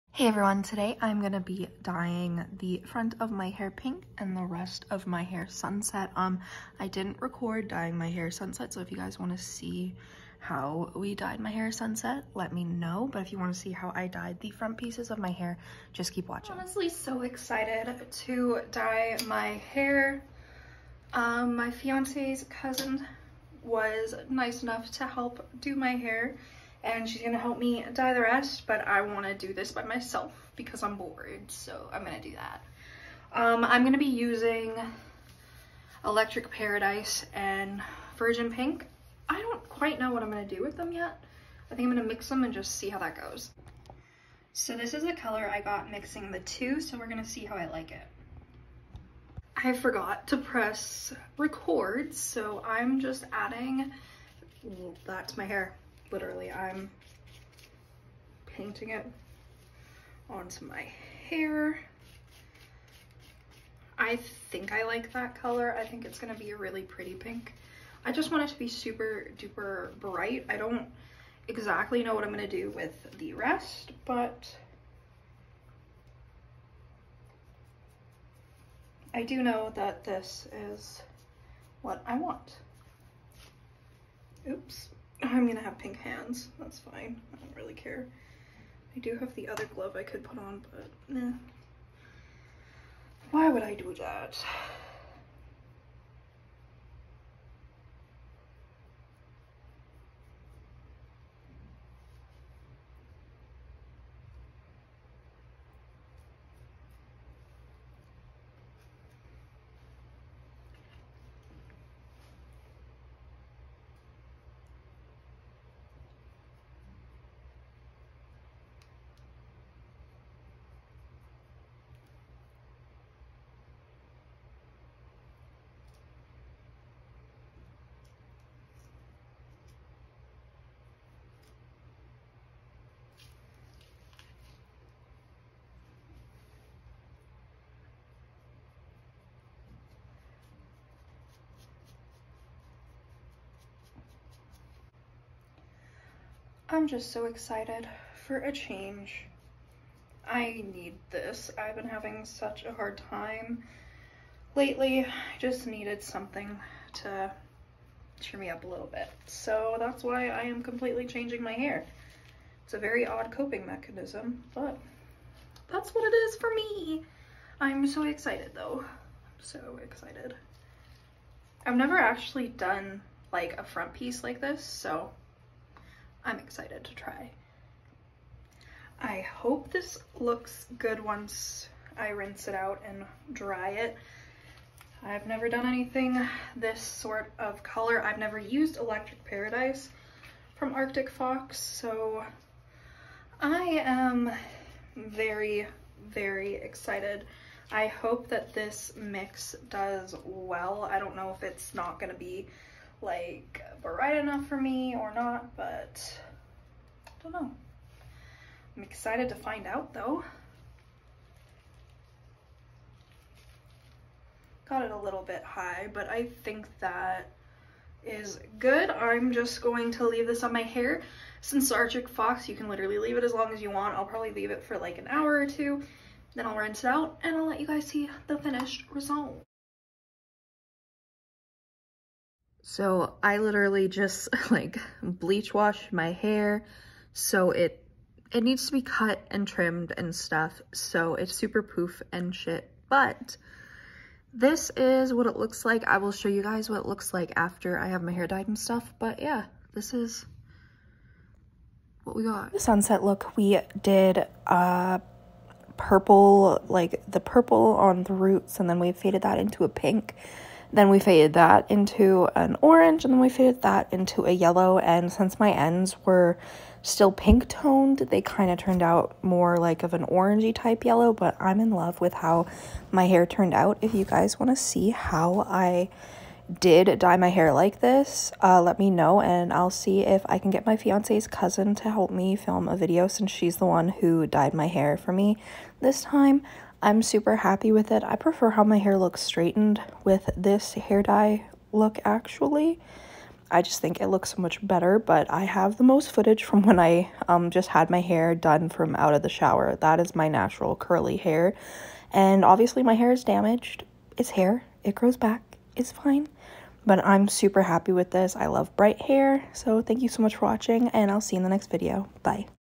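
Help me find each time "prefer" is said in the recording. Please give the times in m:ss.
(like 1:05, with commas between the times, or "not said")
4:48.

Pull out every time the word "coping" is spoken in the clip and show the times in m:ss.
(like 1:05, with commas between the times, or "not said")
2:43.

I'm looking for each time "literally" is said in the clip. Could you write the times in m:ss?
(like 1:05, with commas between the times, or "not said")
0:56, 3:42, 3:53.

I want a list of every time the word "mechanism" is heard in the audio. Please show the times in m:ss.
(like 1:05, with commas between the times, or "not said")
2:43.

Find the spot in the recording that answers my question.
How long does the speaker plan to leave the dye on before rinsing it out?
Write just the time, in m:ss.
3:44.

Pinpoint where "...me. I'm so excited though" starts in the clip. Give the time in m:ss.
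2:46.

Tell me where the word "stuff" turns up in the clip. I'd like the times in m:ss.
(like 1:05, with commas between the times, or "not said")
4:00, 4:08.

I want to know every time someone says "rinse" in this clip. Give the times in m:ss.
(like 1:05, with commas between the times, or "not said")
3:02, 3:46.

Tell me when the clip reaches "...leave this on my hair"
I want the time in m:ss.
3:40.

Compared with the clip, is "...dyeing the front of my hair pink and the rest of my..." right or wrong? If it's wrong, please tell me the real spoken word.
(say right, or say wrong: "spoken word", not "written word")
right.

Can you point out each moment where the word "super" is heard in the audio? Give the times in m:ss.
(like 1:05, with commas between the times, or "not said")
1:08, 4:01, 4:47, 5:07.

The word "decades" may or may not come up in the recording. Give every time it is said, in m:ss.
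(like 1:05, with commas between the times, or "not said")
not said.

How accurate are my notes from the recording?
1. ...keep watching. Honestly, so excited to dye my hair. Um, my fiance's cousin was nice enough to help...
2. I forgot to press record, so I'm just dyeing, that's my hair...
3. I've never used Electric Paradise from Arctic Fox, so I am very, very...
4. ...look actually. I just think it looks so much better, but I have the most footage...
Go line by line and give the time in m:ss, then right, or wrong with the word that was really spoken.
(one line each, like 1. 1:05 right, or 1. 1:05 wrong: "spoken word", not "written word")
1. 0:16 right
2. 0:49 wrong: "adding", not "dyeing"
3. 3:08 right
4. 4:51 right.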